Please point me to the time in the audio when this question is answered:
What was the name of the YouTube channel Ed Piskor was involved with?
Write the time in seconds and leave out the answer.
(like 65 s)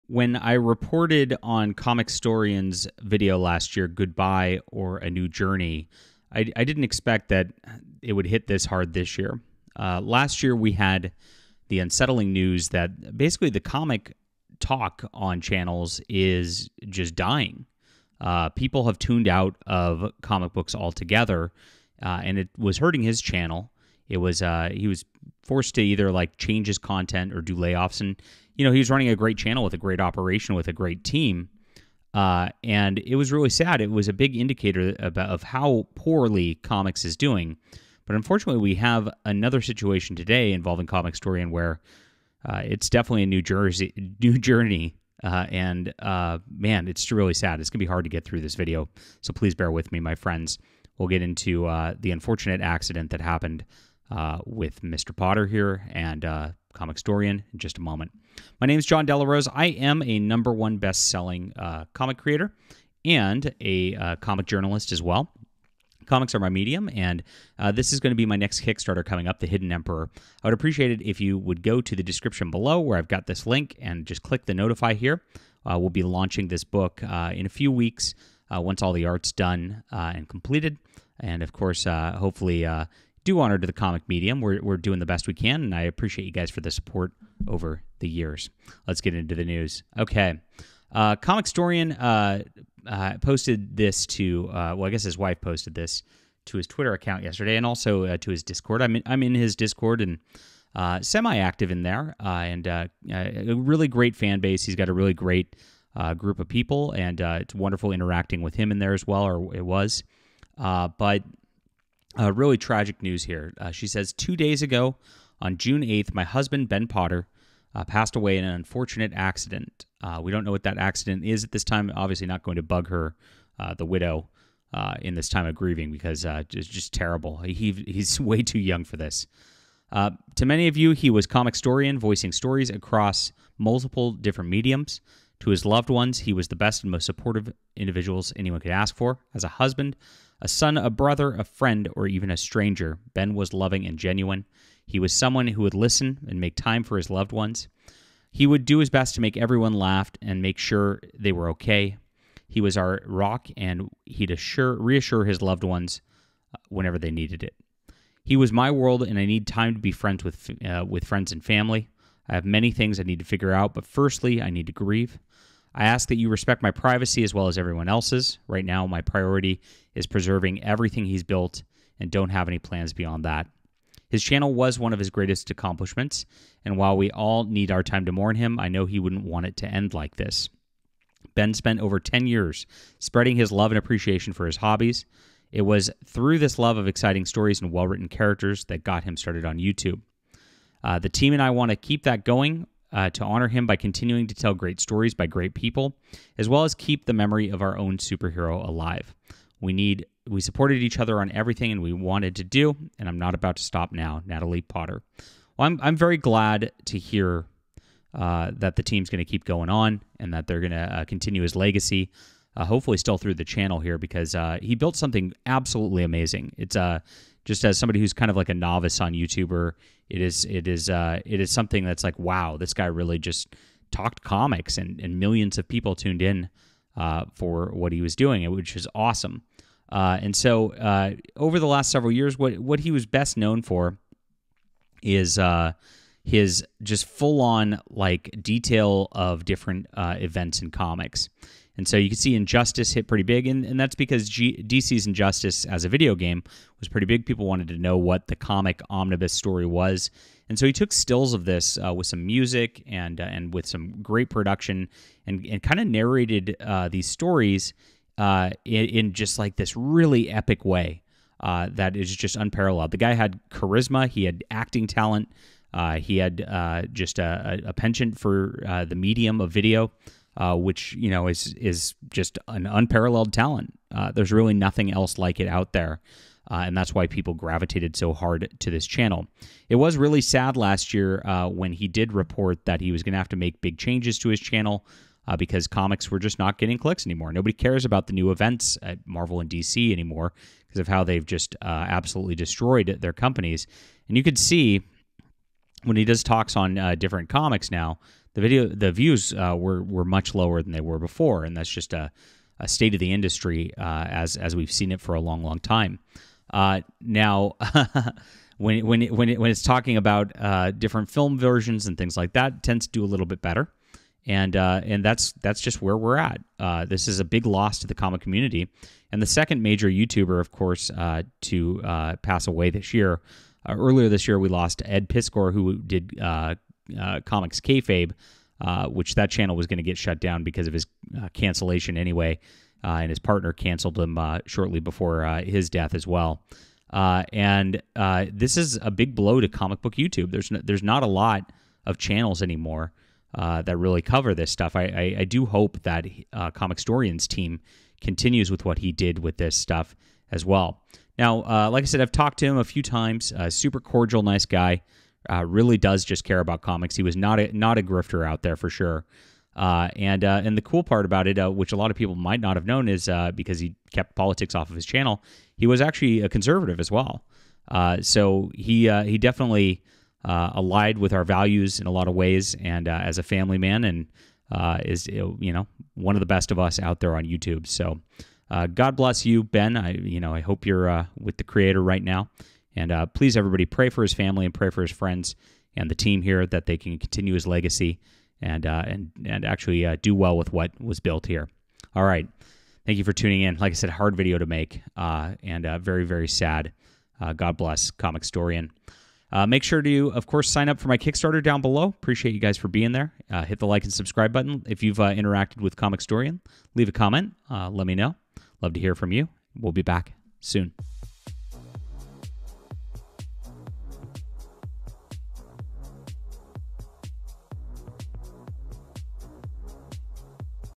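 327 s.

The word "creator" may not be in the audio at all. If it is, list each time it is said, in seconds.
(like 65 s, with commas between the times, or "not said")
62 s, 381 s.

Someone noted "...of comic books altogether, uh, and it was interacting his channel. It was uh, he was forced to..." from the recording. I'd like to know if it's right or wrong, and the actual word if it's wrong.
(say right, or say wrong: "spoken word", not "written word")
wrong: "hurting", not "interacting".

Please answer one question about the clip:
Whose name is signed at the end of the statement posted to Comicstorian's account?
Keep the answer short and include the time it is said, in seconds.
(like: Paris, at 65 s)
Natalie Potter, at 204 s.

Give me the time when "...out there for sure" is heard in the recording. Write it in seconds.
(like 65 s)
358 s.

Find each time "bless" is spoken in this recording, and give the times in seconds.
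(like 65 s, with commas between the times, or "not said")
378 s, 397 s.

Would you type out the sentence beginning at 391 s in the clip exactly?
All right, thank you for tuning in.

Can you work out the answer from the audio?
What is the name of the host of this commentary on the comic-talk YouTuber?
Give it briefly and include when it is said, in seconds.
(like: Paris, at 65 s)
Jon Del Arroz, at 58 s.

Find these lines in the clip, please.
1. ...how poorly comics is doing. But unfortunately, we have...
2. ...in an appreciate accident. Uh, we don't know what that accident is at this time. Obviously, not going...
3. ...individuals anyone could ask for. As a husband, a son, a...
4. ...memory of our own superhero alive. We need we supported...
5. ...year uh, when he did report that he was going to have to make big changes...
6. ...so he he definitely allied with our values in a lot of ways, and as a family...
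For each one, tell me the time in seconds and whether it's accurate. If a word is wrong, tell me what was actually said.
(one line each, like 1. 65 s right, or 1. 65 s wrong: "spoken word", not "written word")
1. 35 s right
2. 118 s wrong: "unfortunate", not "appreciate"
3. 137 s right
4. 197 s right
5. 280 s right
6. 368 s right.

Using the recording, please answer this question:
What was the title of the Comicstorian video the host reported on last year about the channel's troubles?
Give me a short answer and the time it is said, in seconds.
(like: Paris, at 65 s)
Goodbye or A New Journey, at 3 s.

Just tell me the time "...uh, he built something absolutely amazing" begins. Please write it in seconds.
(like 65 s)
214 s.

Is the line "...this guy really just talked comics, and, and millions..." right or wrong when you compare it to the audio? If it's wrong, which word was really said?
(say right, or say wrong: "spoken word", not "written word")
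right.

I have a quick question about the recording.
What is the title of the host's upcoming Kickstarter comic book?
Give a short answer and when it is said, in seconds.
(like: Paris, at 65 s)
The Hidden Emperor, at 69 s.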